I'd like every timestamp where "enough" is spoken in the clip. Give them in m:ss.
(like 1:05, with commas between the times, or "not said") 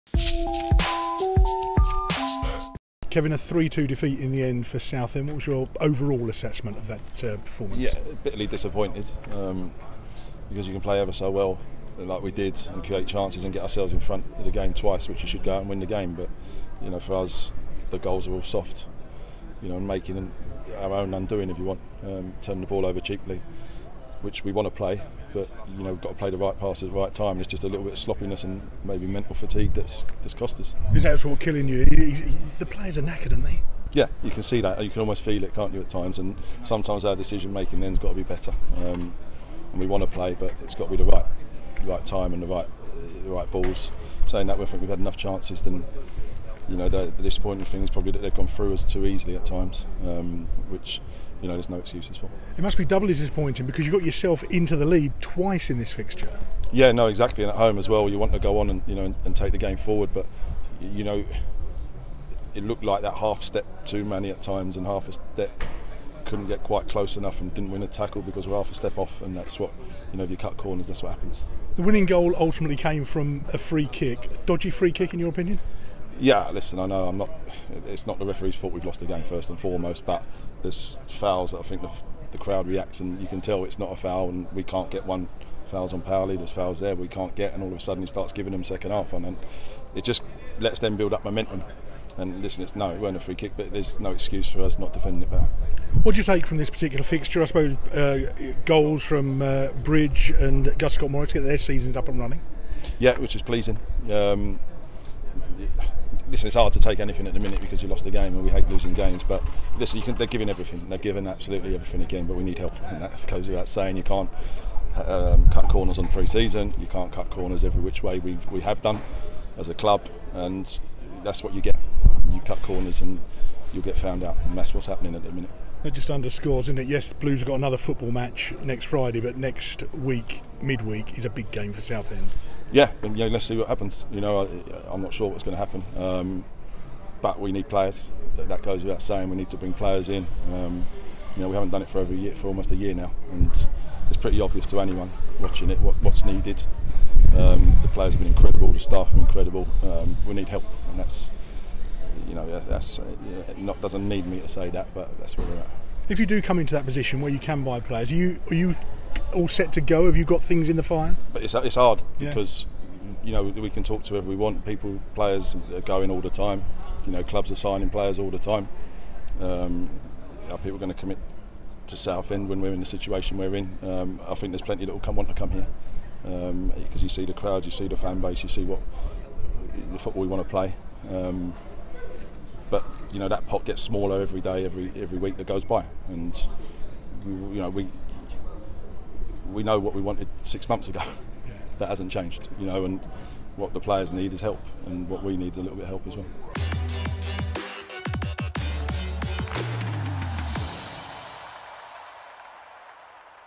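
0:44, 1:07.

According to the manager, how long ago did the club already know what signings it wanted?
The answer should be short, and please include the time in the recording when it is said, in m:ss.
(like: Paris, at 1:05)
6 months, at 3:10.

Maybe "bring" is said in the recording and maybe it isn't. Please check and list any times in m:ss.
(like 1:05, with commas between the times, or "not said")
2:19.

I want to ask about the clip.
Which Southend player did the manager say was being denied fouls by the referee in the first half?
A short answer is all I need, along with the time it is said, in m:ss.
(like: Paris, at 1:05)
Powley, at 1:26.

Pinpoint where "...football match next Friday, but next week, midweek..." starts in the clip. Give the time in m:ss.
2:07.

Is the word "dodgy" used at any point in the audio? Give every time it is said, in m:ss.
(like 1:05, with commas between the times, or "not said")
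1:14.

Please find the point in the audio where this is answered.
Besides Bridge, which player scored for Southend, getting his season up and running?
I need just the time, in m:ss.
1:40.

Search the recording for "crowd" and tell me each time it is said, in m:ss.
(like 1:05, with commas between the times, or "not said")
1:22, 2:57.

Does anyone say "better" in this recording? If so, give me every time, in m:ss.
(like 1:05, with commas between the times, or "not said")
0:38, 1:35.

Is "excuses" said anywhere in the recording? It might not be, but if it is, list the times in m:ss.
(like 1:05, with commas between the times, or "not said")
0:51, 1:34.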